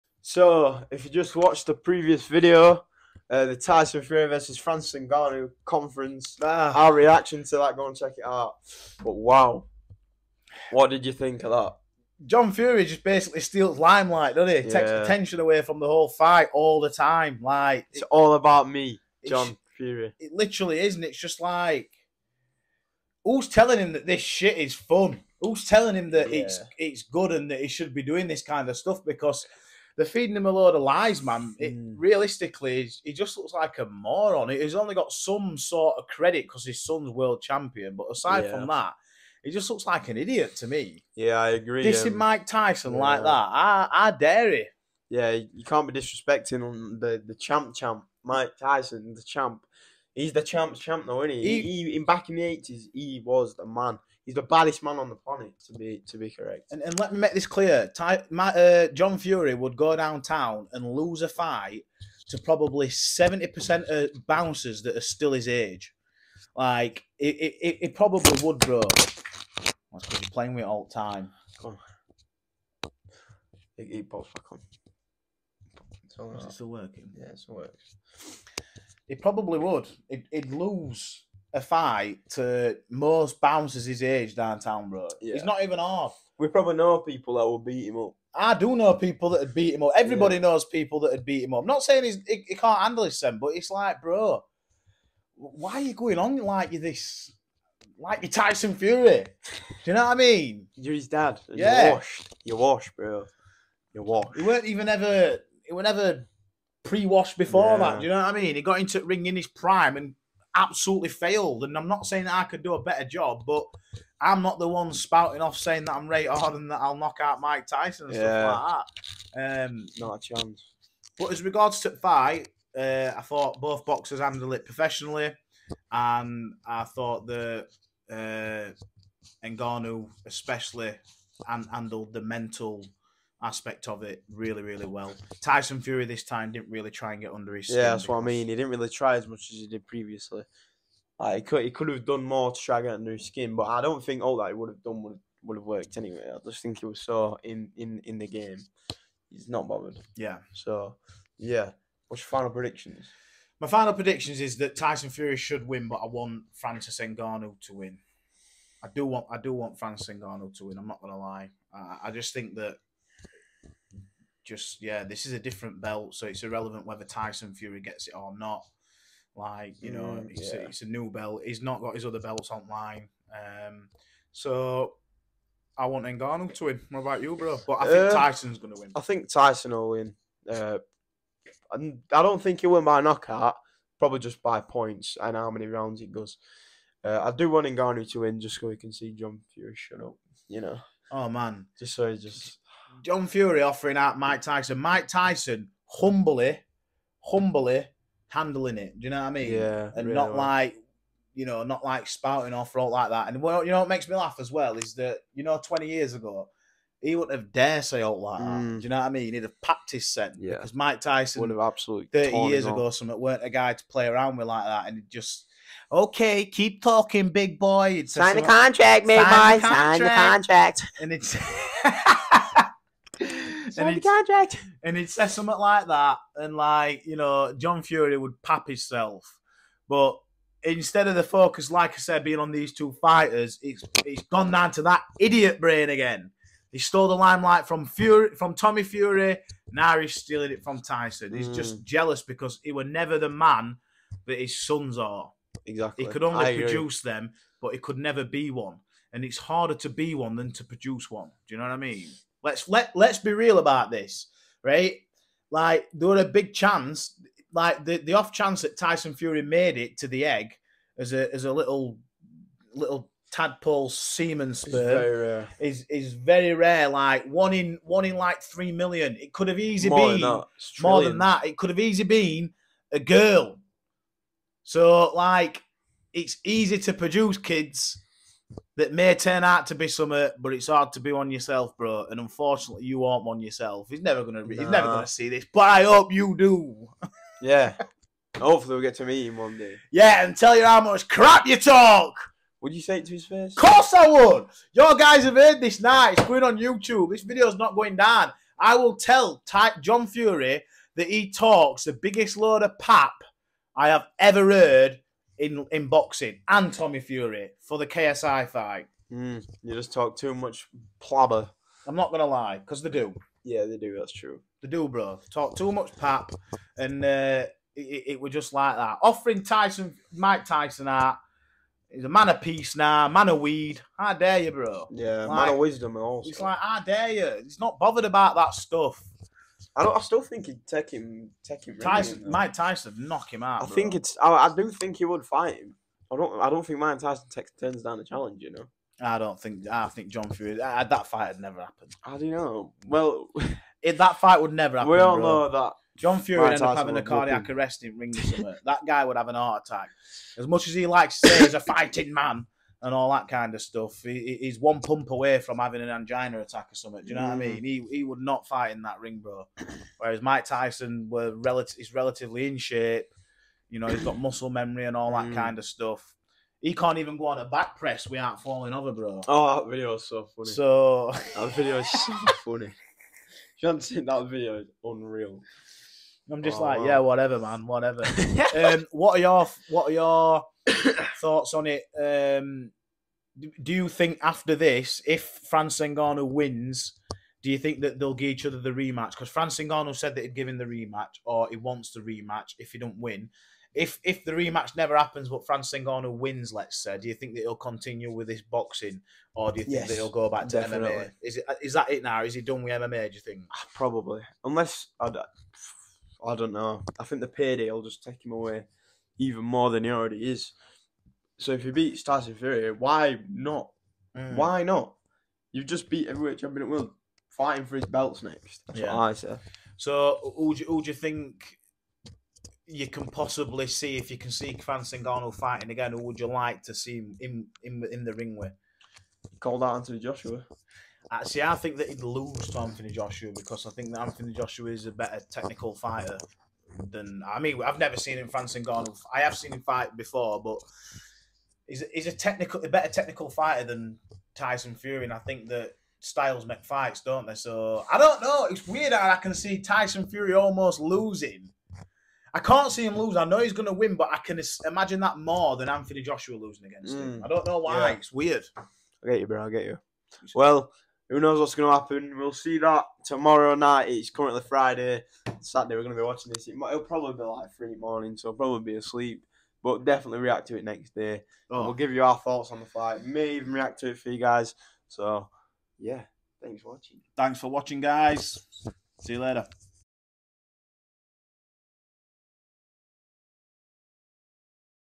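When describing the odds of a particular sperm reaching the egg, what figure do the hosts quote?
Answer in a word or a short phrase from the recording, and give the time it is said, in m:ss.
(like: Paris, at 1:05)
1 in 3 million, at 4:27.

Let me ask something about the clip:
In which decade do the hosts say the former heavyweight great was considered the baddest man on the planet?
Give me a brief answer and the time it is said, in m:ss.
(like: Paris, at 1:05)
The eighties, at 0:52.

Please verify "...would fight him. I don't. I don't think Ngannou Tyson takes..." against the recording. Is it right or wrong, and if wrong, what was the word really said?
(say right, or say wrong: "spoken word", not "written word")
wrong: "Mike", not "Ngannou".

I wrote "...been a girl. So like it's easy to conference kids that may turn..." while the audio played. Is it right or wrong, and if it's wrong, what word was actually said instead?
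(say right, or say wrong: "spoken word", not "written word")
wrong: "produce", not "conference".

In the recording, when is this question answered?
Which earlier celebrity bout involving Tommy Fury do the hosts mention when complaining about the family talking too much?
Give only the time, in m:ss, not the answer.
5:07.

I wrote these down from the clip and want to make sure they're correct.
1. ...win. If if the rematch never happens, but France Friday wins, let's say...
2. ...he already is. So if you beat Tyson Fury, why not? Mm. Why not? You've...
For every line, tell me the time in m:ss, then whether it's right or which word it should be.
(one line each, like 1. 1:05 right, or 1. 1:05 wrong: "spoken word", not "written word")
1. 6:32 wrong: "Ngannou", not "Friday"
2. 6:49 right.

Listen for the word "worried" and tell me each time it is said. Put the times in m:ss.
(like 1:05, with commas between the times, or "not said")
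not said.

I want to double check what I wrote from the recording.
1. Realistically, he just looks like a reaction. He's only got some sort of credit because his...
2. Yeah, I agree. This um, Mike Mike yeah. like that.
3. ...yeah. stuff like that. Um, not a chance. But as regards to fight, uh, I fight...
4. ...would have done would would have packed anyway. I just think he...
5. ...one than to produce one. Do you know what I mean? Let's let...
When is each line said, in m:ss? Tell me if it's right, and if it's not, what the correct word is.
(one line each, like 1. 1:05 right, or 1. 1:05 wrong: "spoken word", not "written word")
1. 0:31 wrong: "moron", not "reaction"
2. 0:41 wrong: "Tyson", not "Mike"
3. 1:58 wrong: "thought", not "fight"
4. 2:24 wrong: "worked", not "packed"
5. 4:10 right.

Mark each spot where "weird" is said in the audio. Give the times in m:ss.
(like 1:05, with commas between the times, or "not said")
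7:28, 7:38.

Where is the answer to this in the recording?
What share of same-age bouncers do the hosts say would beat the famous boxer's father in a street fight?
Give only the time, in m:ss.
1:02.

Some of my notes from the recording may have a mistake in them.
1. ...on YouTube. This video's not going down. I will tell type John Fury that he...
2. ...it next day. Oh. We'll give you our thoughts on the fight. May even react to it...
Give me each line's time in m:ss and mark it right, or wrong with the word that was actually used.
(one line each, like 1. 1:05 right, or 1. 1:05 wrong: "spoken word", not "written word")
1. 4:56 right
2. 7:50 right.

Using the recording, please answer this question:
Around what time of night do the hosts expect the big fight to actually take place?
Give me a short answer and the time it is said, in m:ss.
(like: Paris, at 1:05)
3 in the morning, at 7:47.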